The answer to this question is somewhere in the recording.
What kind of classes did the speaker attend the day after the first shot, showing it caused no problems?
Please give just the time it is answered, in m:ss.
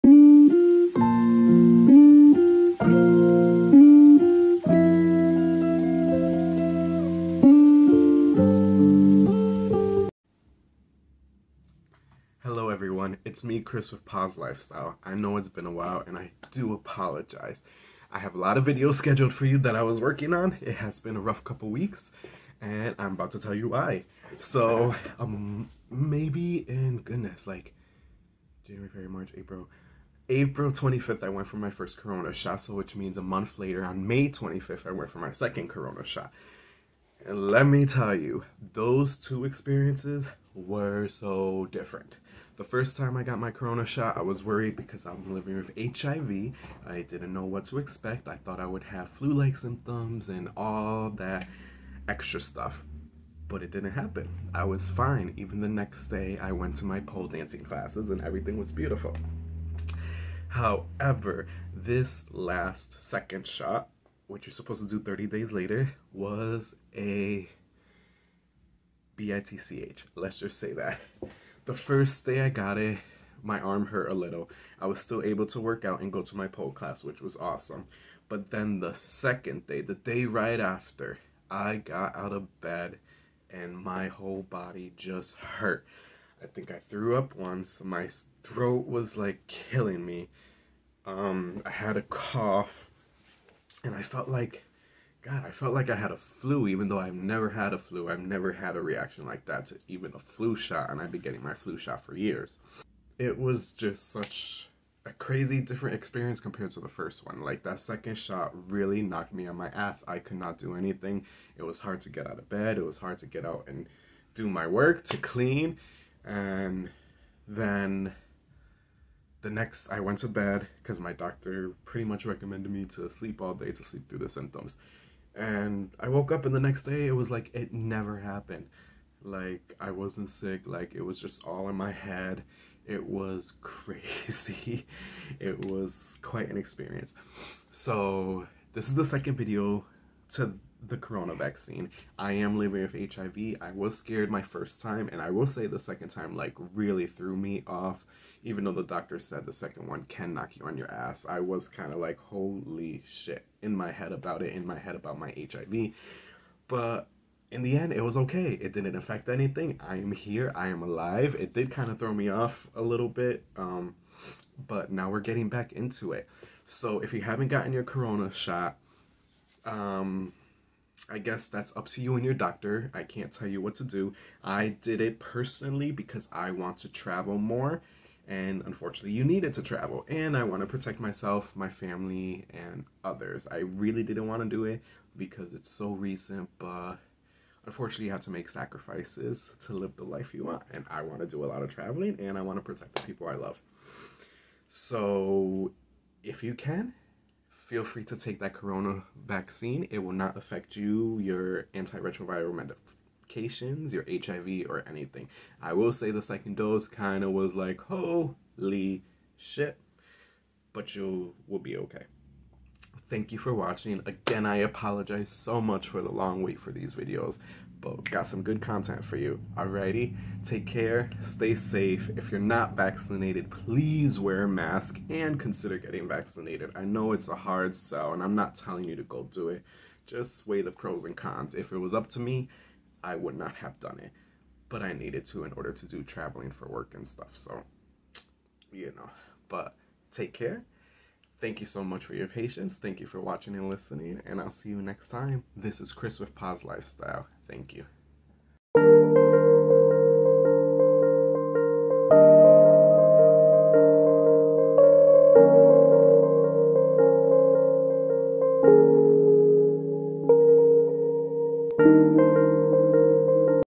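0:57.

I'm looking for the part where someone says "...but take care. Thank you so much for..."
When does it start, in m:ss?
3:59.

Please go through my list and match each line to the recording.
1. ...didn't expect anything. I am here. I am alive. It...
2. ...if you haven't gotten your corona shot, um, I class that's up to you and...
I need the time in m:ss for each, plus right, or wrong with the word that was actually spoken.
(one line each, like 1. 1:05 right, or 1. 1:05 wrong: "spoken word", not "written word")
1. 2:38 wrong: "affect", not "expect"
2. 2:47 wrong: "guess", not "class".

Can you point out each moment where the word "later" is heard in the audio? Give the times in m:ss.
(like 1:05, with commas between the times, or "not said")
0:33, 1:05.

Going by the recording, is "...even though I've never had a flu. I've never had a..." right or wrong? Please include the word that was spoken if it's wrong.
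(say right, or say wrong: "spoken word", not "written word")
right.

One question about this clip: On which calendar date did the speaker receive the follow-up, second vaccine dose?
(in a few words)
May 25th.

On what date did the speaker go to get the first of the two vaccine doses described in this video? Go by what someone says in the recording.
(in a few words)
April 25th.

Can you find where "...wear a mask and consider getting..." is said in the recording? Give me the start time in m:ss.
3:44.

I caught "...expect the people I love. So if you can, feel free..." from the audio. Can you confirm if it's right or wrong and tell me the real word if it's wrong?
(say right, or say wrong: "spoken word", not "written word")
wrong: "protect", not "expect".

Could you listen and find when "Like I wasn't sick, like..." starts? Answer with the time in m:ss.
2:09.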